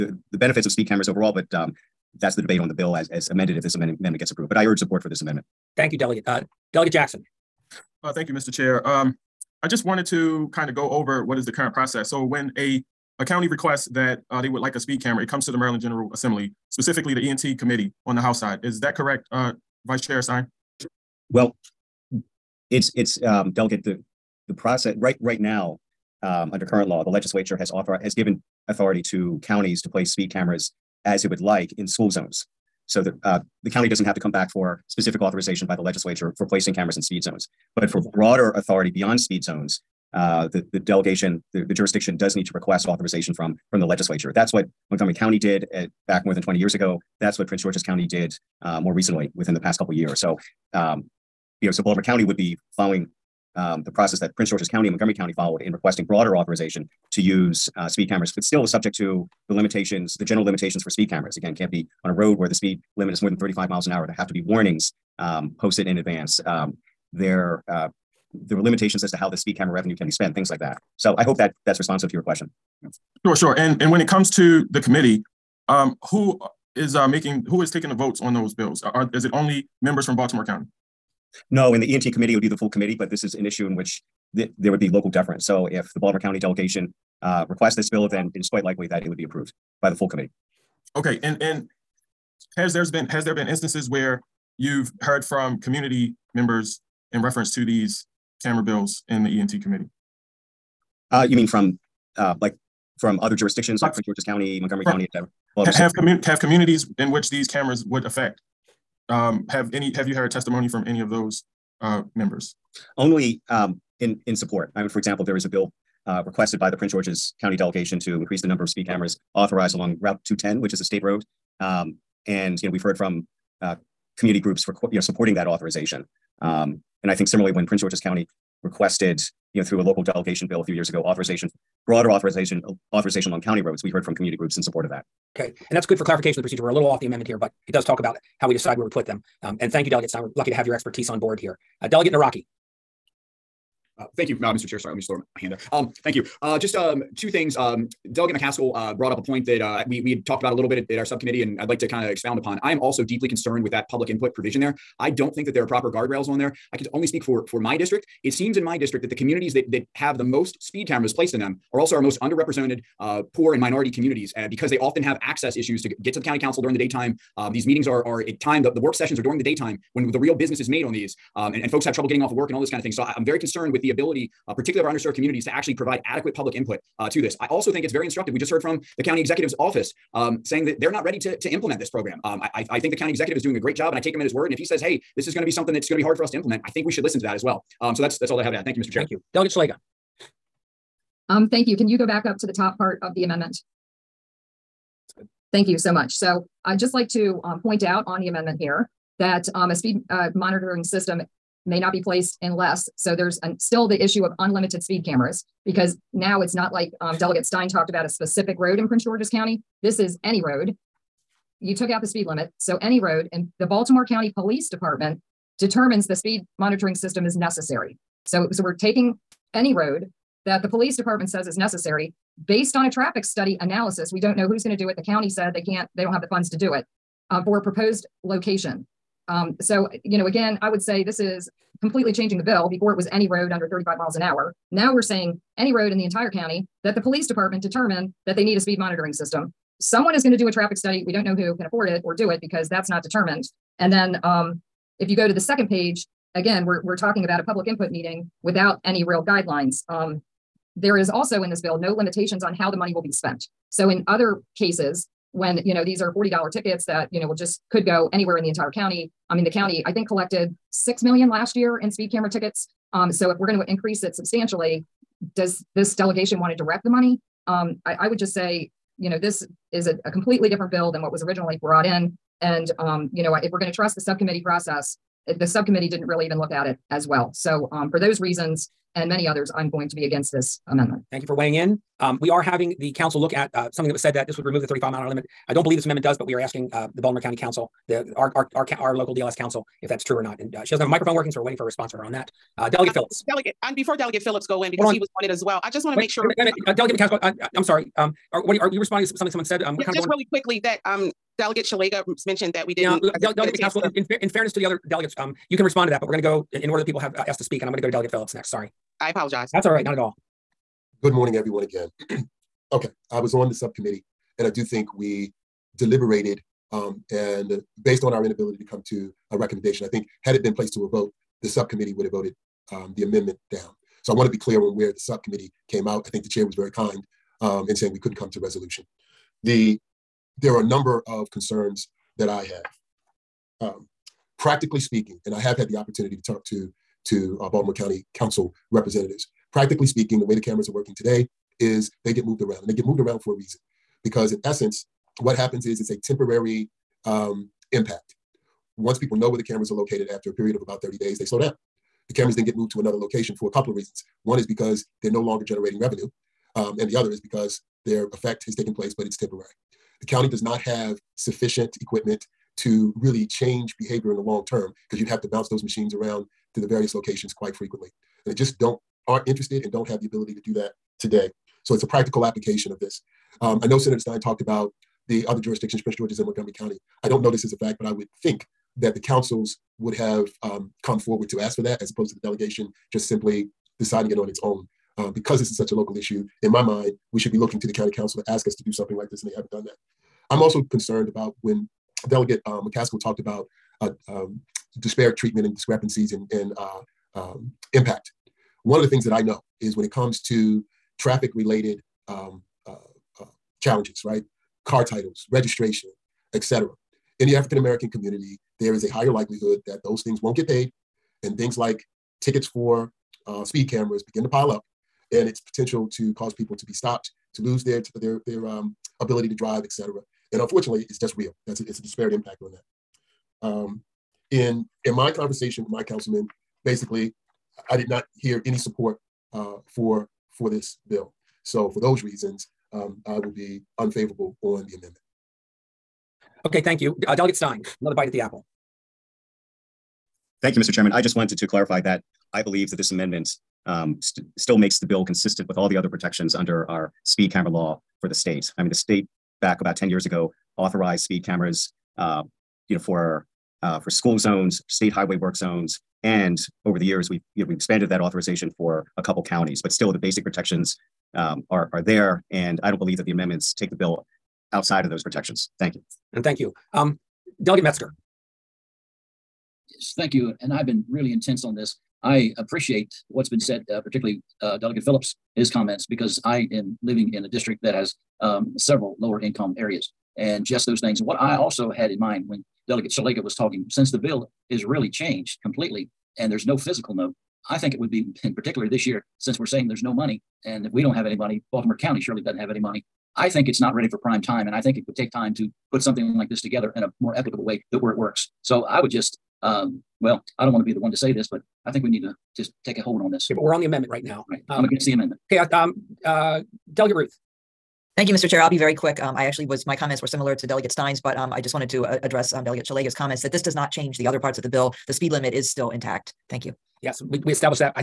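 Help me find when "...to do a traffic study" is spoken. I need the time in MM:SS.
04:00.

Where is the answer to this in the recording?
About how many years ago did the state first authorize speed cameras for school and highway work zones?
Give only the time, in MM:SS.
07:29.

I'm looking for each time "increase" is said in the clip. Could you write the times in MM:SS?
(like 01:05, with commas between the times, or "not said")
01:58, 04:23.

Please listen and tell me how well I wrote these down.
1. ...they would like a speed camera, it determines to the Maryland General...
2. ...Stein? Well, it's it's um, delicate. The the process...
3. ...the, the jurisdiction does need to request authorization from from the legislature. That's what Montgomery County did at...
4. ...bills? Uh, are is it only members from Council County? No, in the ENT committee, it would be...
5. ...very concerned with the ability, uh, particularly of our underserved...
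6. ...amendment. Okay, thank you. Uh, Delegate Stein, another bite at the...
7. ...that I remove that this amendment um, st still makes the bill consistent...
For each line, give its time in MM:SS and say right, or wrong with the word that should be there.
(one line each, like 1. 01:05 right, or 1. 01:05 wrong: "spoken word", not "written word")
1. 00:14 wrong: "comes", not "determines"
2. 00:20 right
3. 00:41 right
4. 01:18 wrong: "Baltimore", not "Council"
5. 02:53 right
6. 07:14 right
7. 07:21 wrong: "believe", not "remove".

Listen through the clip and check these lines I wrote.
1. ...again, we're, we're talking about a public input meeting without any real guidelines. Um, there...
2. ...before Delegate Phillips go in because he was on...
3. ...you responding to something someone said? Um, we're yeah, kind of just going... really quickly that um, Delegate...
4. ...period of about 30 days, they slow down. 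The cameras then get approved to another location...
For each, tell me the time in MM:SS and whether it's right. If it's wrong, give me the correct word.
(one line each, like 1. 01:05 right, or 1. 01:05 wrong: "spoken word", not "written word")
1. 04:06 right
2. 04:53 right
3. 04:58 right
4. 05:50 wrong: "moved", not "approved".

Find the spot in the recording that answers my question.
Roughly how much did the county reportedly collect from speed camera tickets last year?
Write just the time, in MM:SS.
04:20.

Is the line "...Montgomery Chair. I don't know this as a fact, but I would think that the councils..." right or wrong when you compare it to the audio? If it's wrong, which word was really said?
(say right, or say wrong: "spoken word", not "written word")
wrong: "County", not "Chair".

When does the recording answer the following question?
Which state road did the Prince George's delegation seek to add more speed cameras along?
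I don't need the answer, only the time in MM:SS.
02:00.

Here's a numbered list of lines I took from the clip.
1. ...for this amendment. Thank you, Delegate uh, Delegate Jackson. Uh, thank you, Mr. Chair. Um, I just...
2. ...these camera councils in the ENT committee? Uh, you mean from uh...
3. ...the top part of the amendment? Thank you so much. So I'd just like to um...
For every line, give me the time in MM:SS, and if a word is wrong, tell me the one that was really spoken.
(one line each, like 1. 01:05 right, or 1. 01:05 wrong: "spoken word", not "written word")
1. 00:05 right
2. 01:37 wrong: "bills", not "councils"
3. 03:12 right.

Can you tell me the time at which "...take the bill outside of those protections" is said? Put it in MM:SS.
07:43.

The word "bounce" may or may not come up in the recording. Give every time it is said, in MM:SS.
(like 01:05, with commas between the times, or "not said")
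06:05.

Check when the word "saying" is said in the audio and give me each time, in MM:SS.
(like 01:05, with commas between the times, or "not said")
03:00, 03:55, 05:27, 08:09.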